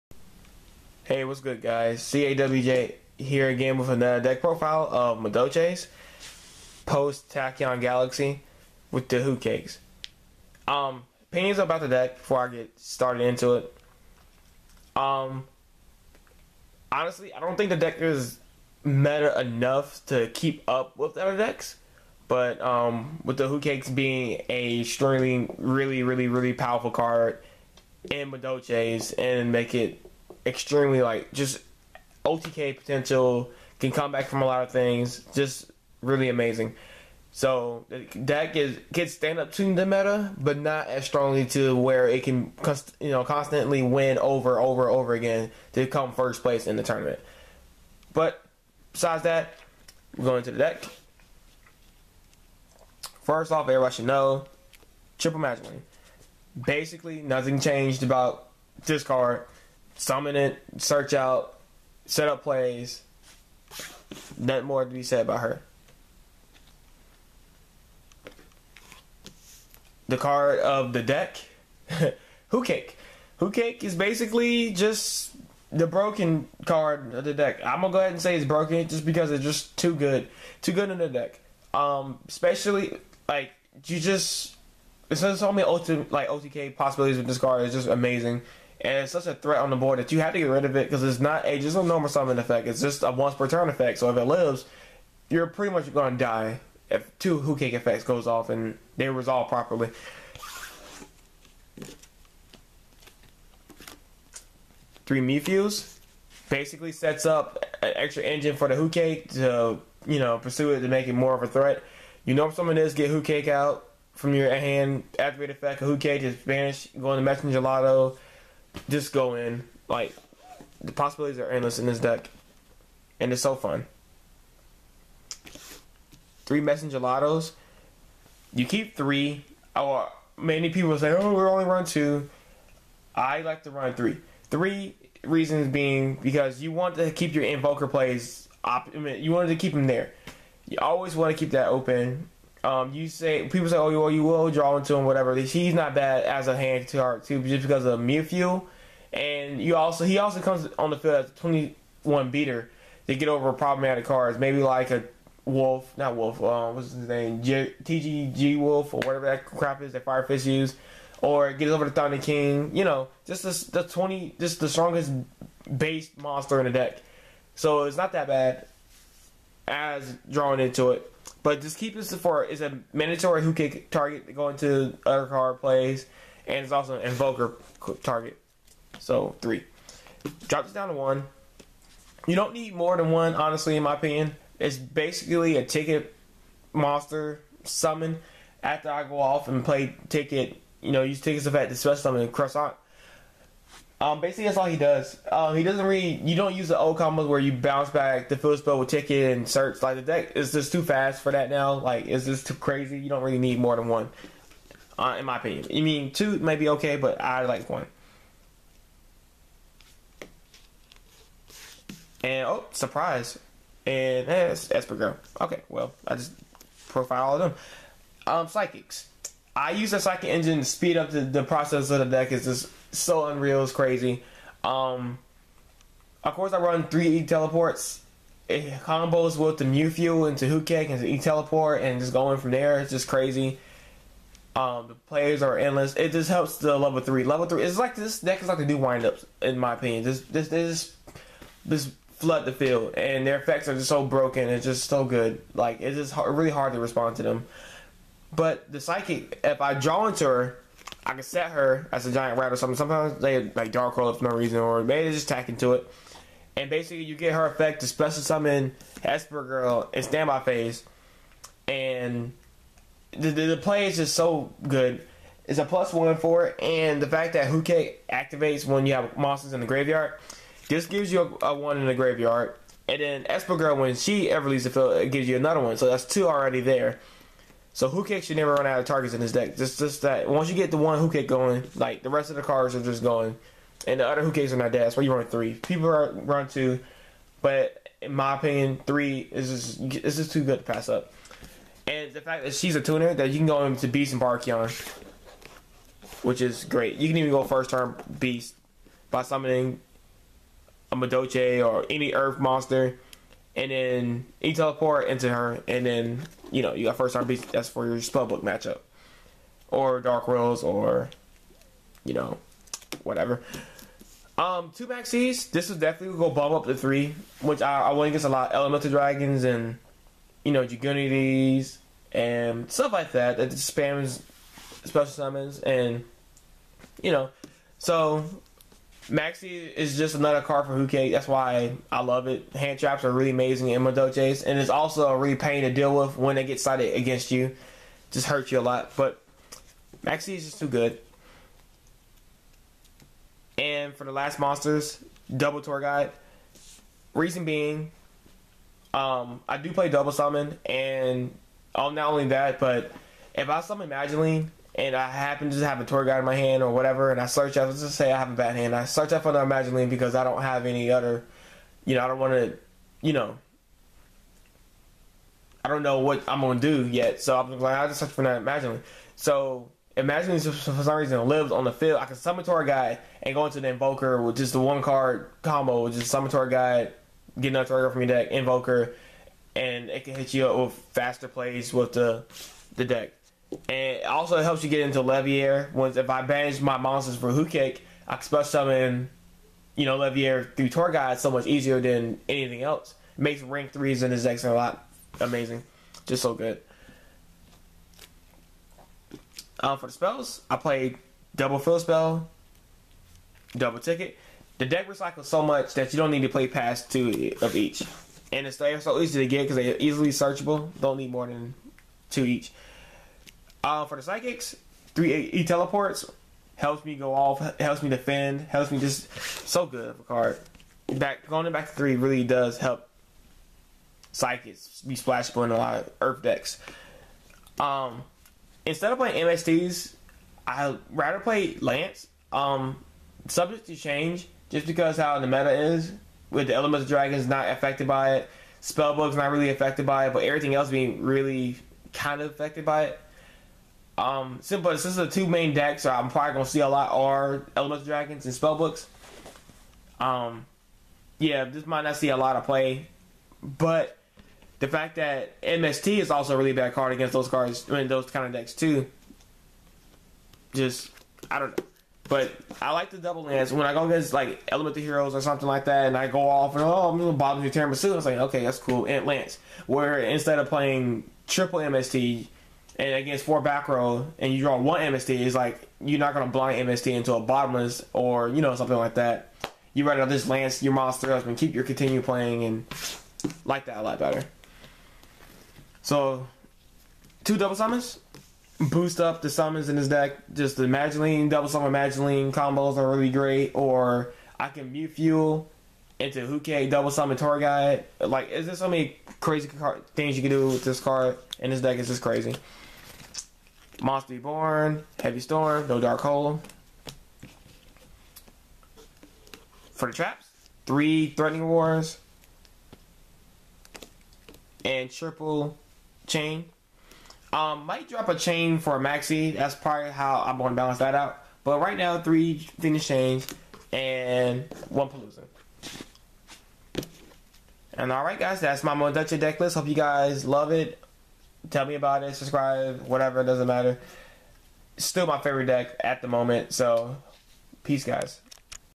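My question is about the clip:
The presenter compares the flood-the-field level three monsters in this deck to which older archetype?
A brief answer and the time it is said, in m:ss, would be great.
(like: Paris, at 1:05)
windups, at 3:58.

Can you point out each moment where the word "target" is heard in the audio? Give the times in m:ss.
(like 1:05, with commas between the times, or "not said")
2:53, 2:58, 4:38.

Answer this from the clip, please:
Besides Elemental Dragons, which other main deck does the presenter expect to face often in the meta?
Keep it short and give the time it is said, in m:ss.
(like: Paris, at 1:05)
Spellbooks, at 7:28.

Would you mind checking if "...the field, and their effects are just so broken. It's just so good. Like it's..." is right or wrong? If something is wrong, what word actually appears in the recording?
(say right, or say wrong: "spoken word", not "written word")
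right.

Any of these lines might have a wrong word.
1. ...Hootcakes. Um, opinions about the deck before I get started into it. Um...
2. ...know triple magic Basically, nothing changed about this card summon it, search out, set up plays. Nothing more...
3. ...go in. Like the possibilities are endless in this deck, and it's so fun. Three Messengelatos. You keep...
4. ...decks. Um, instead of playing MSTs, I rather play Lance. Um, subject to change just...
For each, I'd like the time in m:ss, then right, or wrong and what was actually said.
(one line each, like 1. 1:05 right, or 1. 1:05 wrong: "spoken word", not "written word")
1. 0:09 right
2. 0:54 right
3. 1:59 right
4. 7:06 right.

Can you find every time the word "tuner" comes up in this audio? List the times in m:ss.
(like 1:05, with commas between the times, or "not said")
4:52.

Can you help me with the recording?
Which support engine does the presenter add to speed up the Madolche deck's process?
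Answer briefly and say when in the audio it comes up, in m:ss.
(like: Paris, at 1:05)
psychic engine, at 3:39.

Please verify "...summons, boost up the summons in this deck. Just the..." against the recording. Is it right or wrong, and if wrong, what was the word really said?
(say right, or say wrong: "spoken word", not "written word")
right.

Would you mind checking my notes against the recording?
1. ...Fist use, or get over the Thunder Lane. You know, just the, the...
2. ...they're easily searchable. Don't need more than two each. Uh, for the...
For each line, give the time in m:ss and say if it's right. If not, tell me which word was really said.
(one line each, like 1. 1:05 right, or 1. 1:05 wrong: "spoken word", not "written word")
1. 2:40 wrong: "King", not "Lane"
2. 6:49 right.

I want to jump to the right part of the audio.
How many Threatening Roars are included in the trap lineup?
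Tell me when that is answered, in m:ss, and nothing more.
8:30.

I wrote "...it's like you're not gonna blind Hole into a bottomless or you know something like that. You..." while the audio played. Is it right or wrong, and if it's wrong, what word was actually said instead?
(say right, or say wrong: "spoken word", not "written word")
wrong: "MST", not "Hole".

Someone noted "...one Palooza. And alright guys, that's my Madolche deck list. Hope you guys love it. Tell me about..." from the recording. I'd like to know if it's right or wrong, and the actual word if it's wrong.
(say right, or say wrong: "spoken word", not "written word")
right.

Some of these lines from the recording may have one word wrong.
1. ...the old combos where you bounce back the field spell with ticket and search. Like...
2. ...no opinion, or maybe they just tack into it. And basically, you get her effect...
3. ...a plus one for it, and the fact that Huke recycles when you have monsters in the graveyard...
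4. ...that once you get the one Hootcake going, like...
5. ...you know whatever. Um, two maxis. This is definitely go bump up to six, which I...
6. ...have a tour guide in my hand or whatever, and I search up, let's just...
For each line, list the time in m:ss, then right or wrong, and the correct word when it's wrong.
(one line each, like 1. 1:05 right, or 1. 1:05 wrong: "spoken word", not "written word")
1. 3:16 right
2. 4:14 wrong: "reason", not "opinion"
3. 4:25 wrong: "activates", not "recycles"
4. 4:40 right
5. 5:12 wrong: "three", not "six"
6. 5:55 right.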